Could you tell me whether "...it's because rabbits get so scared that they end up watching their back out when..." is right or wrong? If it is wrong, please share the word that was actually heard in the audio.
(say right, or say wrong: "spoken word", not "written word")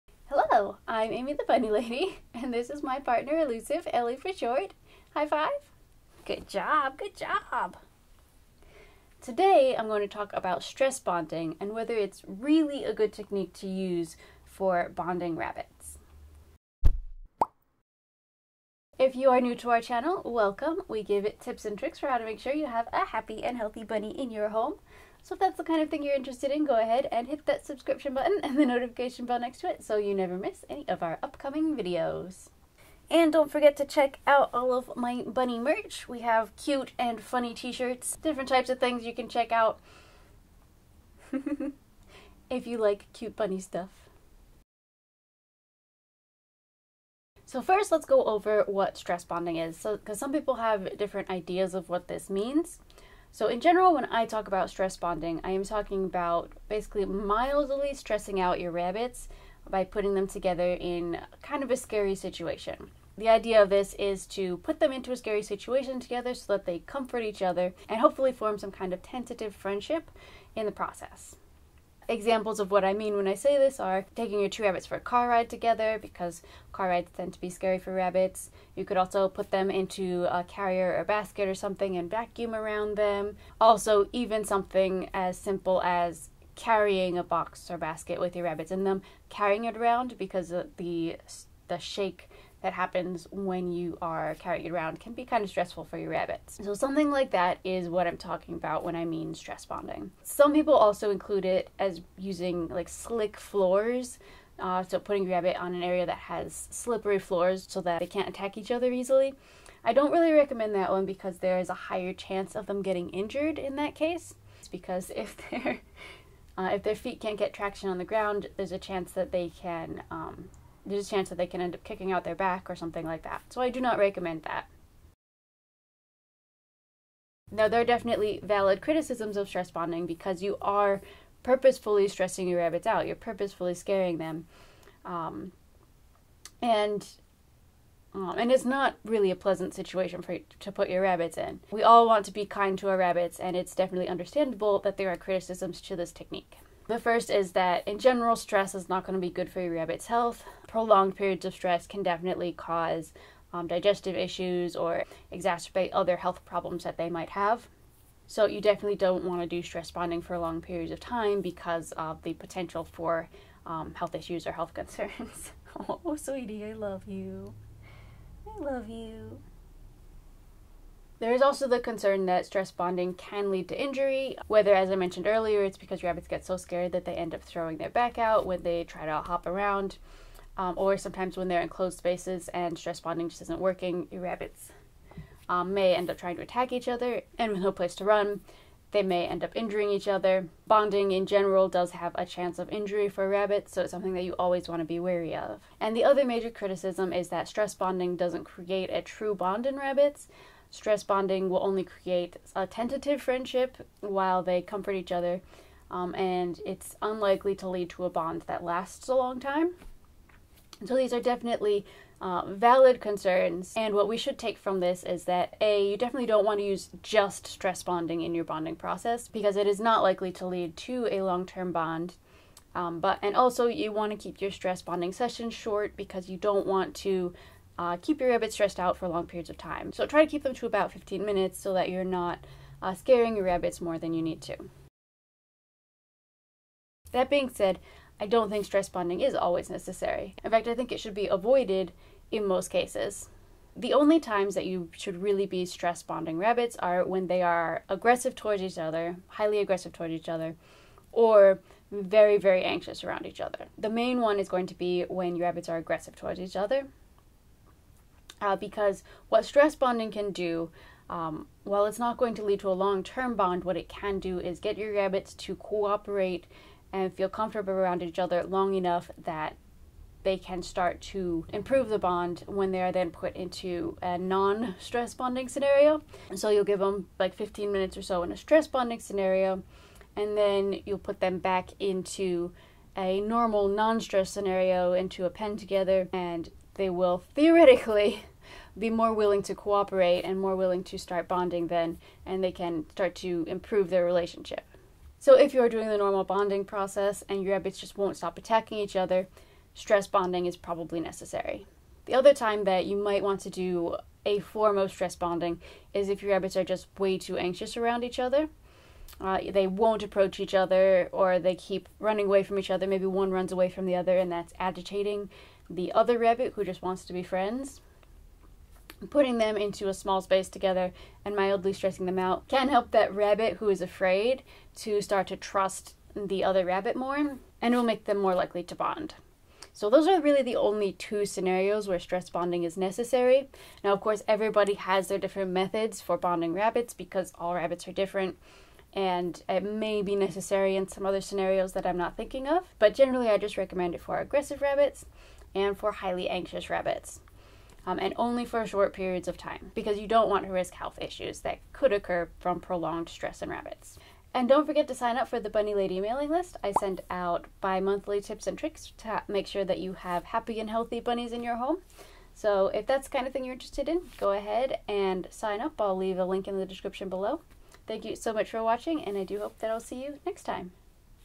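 wrong: "throwing", not "watching".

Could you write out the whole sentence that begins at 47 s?
So first let's go over what stress bonding is.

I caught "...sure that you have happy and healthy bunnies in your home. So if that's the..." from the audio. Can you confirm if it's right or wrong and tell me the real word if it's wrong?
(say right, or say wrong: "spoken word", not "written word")
right.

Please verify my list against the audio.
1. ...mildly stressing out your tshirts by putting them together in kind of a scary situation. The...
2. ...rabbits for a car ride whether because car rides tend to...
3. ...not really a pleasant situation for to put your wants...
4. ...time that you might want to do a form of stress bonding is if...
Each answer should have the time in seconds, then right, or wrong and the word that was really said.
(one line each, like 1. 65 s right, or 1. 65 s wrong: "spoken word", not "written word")
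1. 57 s wrong: "rabbits", not "tshirts"
2. 74 s wrong: "together", not "whether"
3. 138 s wrong: "rabbits", not "wants"
4. 302 s right.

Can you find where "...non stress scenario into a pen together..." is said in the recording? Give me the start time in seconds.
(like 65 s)
283 s.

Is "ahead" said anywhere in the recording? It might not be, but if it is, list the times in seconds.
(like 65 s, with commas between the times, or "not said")
26 s, 364 s.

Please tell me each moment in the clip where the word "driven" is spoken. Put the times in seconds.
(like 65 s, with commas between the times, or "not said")
not said.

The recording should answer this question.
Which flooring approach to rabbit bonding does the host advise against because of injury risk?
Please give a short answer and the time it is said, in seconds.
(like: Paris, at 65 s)
slick floors, at 102 s.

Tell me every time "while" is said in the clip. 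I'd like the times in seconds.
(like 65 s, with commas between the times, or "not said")
204 s, 261 s.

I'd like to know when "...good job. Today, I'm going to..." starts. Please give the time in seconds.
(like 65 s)
6 s.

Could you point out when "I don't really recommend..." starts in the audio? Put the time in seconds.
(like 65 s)
109 s.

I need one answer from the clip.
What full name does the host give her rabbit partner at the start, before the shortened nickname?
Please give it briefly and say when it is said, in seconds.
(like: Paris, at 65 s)
Elusive, at 3 s.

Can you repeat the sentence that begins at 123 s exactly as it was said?
So I do not recommend that.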